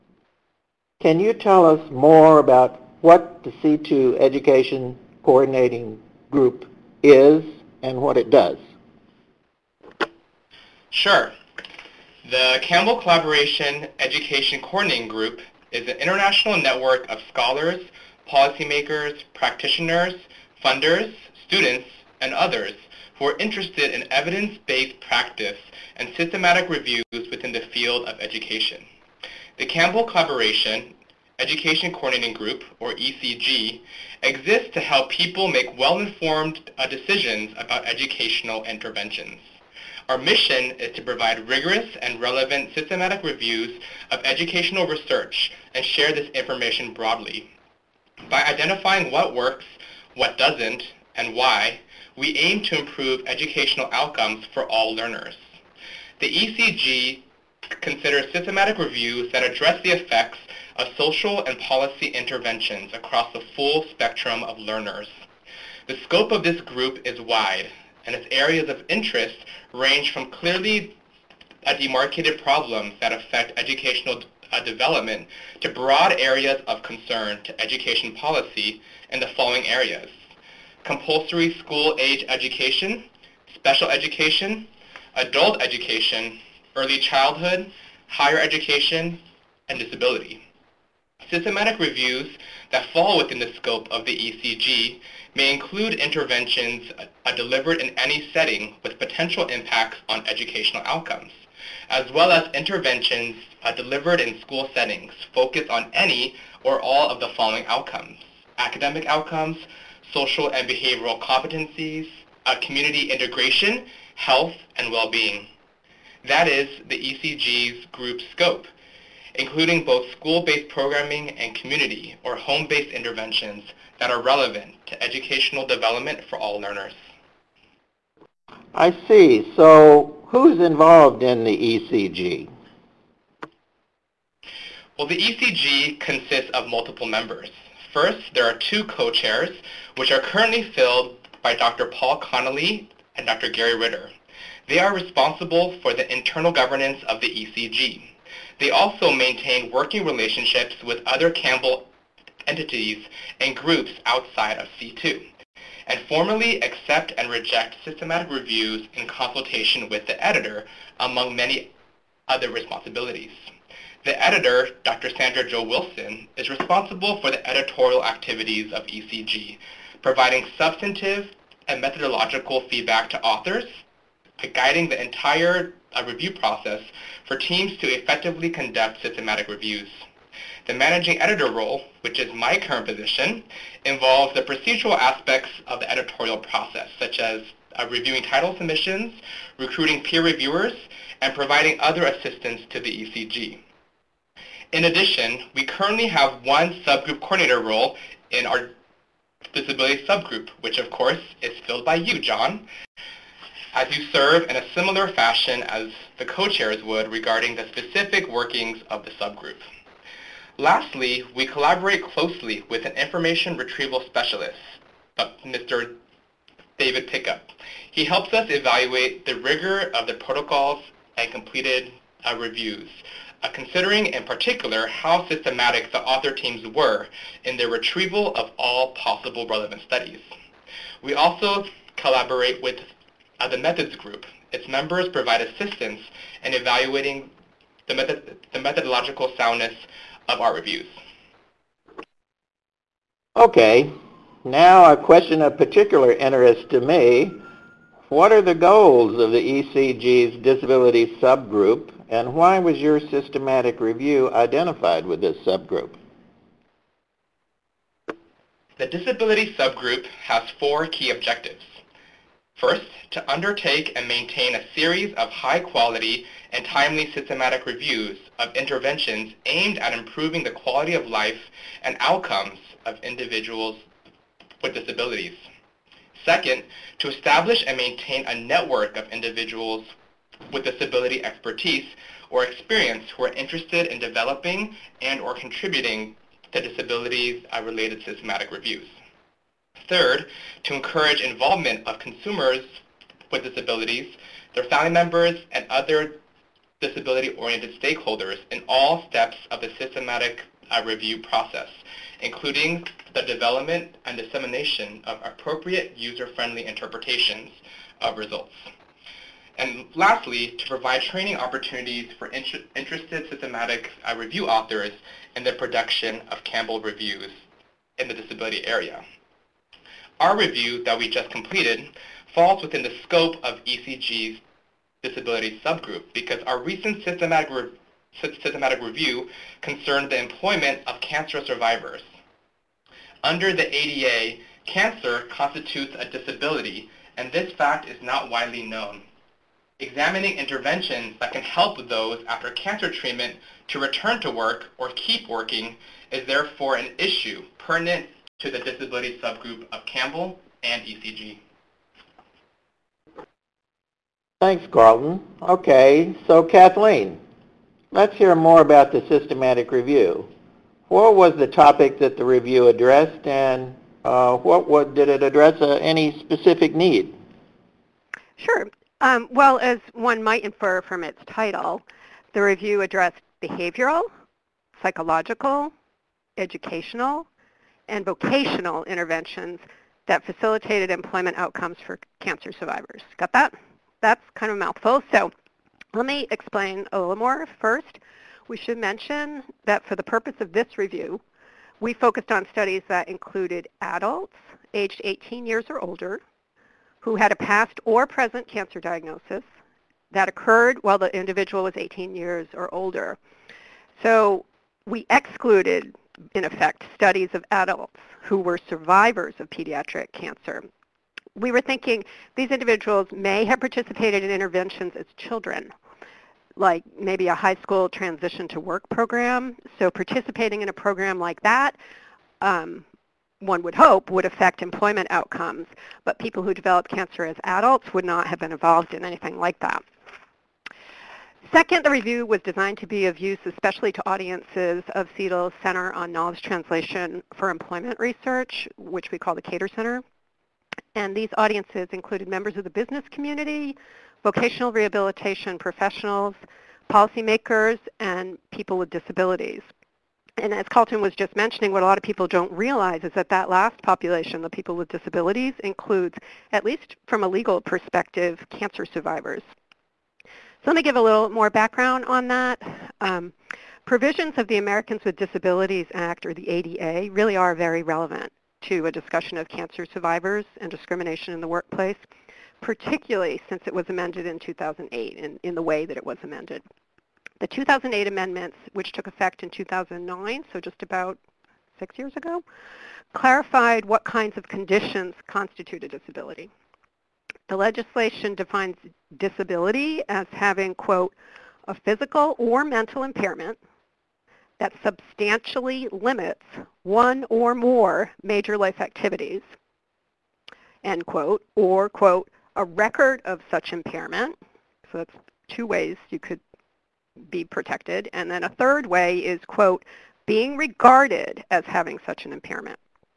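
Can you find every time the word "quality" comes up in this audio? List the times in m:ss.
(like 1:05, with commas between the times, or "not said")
4:25, 4:30.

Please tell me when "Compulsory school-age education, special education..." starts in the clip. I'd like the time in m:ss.
1:20.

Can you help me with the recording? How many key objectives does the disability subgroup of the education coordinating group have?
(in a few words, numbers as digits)
4.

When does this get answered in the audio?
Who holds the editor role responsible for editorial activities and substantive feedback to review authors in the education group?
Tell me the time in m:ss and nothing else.
2:44.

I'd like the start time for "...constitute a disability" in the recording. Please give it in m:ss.
8:05.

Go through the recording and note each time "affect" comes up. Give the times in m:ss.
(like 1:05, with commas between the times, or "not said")
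1:13, 7:04.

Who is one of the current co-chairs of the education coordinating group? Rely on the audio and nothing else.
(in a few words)
Paul Connolly.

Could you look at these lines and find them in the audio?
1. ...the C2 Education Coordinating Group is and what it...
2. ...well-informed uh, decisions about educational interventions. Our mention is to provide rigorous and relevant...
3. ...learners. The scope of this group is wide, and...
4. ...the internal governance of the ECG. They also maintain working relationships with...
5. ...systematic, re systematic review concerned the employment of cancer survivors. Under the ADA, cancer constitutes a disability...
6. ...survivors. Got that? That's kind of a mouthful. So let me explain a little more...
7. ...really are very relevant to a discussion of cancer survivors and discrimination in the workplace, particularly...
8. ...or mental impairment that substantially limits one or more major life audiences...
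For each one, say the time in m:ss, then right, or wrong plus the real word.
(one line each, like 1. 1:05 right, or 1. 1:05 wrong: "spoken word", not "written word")
1. 0:03 right
2. 0:35 wrong: "mission", not "mention"
3. 1:04 right
4. 2:25 right
5. 5:27 right
6. 6:22 right
7. 7:47 right
8. 8:12 wrong: "activities", not "audiences".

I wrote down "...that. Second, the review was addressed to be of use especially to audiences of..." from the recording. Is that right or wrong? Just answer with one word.
wrong.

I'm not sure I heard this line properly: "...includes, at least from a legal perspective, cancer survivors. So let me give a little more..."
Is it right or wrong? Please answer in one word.
right.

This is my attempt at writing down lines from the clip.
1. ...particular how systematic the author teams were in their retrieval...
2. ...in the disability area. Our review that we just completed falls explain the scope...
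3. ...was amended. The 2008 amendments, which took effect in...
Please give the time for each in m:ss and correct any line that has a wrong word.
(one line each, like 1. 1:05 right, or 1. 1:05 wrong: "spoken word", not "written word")
1. 3:44 right
2. 5:17 wrong: "within", not "explain"
3. 7:56 right.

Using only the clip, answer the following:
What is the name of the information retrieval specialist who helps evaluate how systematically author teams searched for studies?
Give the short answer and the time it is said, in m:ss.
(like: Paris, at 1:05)
David Pickup, at 3:35.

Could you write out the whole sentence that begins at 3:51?
We also collaborate with uh, the methods group.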